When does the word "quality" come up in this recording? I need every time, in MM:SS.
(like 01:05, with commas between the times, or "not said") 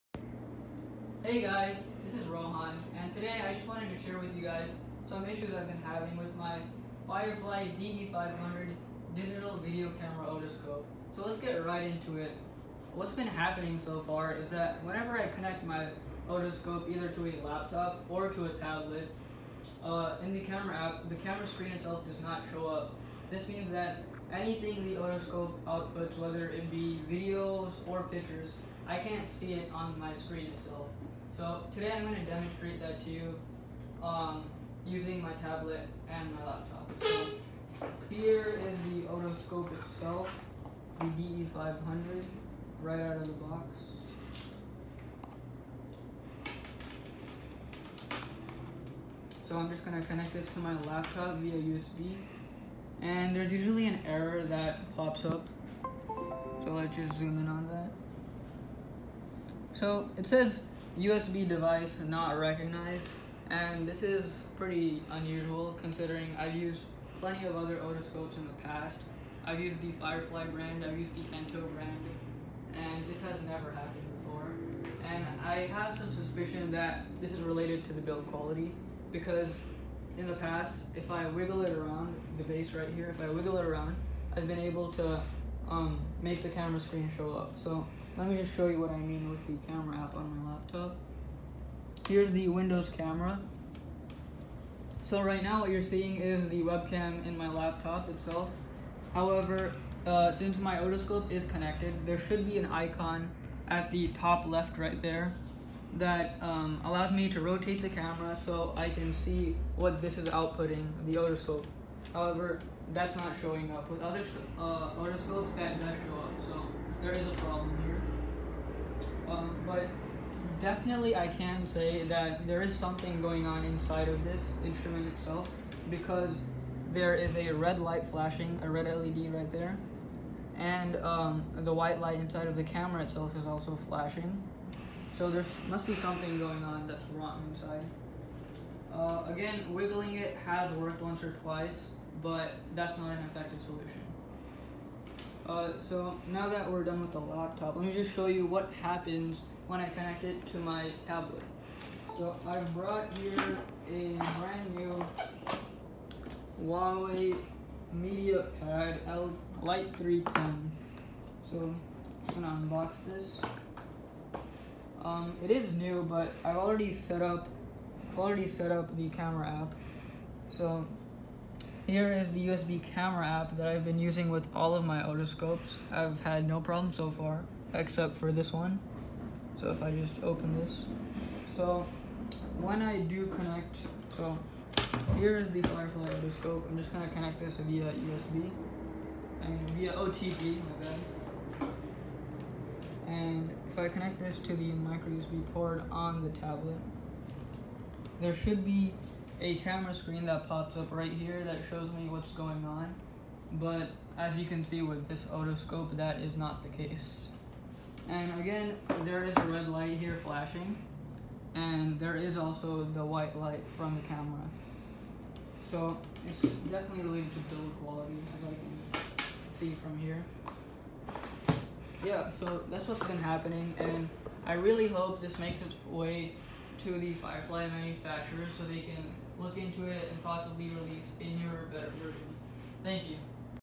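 01:18, 03:37.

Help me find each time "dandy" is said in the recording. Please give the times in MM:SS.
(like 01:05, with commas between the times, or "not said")
not said.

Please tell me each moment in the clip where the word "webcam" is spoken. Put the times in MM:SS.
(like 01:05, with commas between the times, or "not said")
01:36.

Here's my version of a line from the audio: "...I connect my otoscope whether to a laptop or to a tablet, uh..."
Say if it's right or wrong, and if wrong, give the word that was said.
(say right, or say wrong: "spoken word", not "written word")
wrong: "either", not "whether".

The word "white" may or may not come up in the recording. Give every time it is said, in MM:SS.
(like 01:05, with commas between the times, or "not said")
02:11, 03:33.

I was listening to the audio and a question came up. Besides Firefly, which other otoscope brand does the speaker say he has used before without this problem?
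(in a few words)
Ento.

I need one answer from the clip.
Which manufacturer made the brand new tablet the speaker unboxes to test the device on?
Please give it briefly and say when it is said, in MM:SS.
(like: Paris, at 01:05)
Huawei, at 02:36.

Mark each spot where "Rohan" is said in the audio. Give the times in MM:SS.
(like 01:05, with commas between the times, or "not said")
00:02.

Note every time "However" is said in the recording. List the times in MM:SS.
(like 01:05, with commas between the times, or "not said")
01:39, 01:52.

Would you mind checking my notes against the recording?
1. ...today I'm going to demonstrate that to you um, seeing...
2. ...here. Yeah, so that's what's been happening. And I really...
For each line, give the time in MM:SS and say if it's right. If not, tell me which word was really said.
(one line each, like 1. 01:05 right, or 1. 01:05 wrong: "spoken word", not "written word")
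1. 00:31 wrong: "using", not "seeing"
2. 03:39 right.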